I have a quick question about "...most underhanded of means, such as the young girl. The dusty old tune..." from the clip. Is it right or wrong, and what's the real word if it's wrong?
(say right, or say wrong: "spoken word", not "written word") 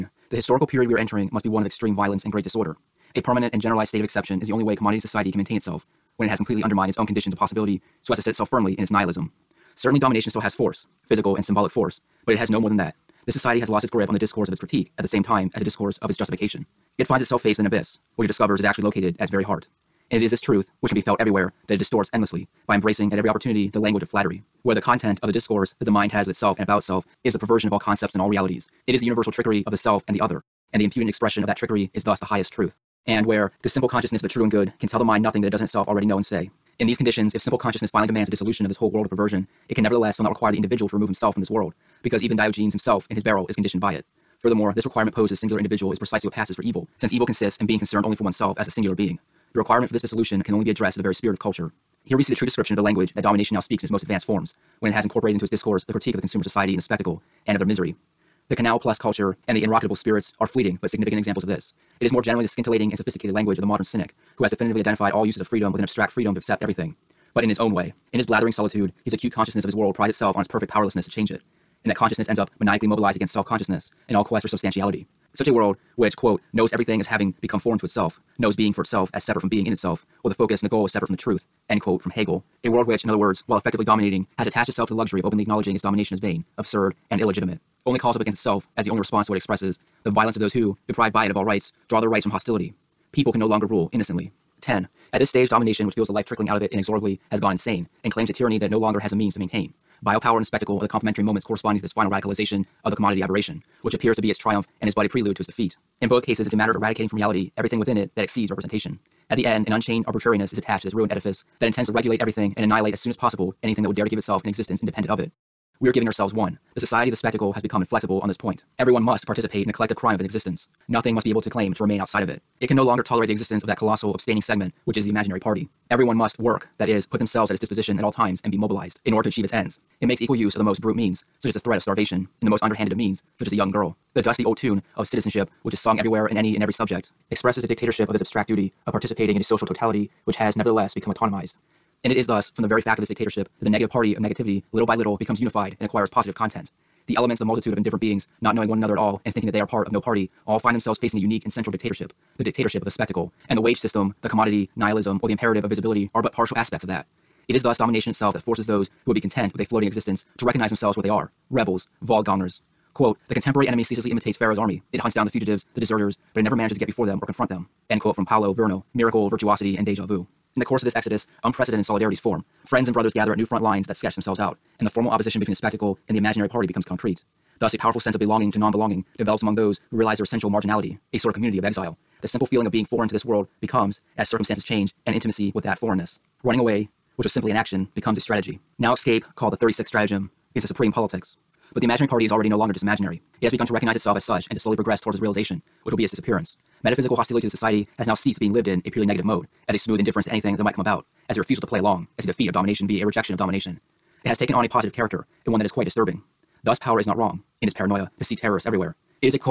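right.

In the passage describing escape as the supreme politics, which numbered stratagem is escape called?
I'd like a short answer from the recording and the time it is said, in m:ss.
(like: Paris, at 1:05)
36th stratagem, at 3:09.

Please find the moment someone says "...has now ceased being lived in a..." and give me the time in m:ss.
3:17.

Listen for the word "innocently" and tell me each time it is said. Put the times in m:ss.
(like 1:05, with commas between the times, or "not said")
1:33.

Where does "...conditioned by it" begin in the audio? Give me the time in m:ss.
0:43.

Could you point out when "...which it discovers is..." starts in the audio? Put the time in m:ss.
0:18.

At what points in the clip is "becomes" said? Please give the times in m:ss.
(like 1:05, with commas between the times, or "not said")
1:17, 1:57, 2:20, 2:25, 2:56, 3:03, 3:07.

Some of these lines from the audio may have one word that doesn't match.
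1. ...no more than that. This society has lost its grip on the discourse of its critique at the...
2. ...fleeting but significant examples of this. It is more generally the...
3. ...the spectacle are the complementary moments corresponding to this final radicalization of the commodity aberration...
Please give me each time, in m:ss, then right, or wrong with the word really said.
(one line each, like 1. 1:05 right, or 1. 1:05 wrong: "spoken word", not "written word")
1. 0:12 right
2. 1:00 right
3. 1:40 right.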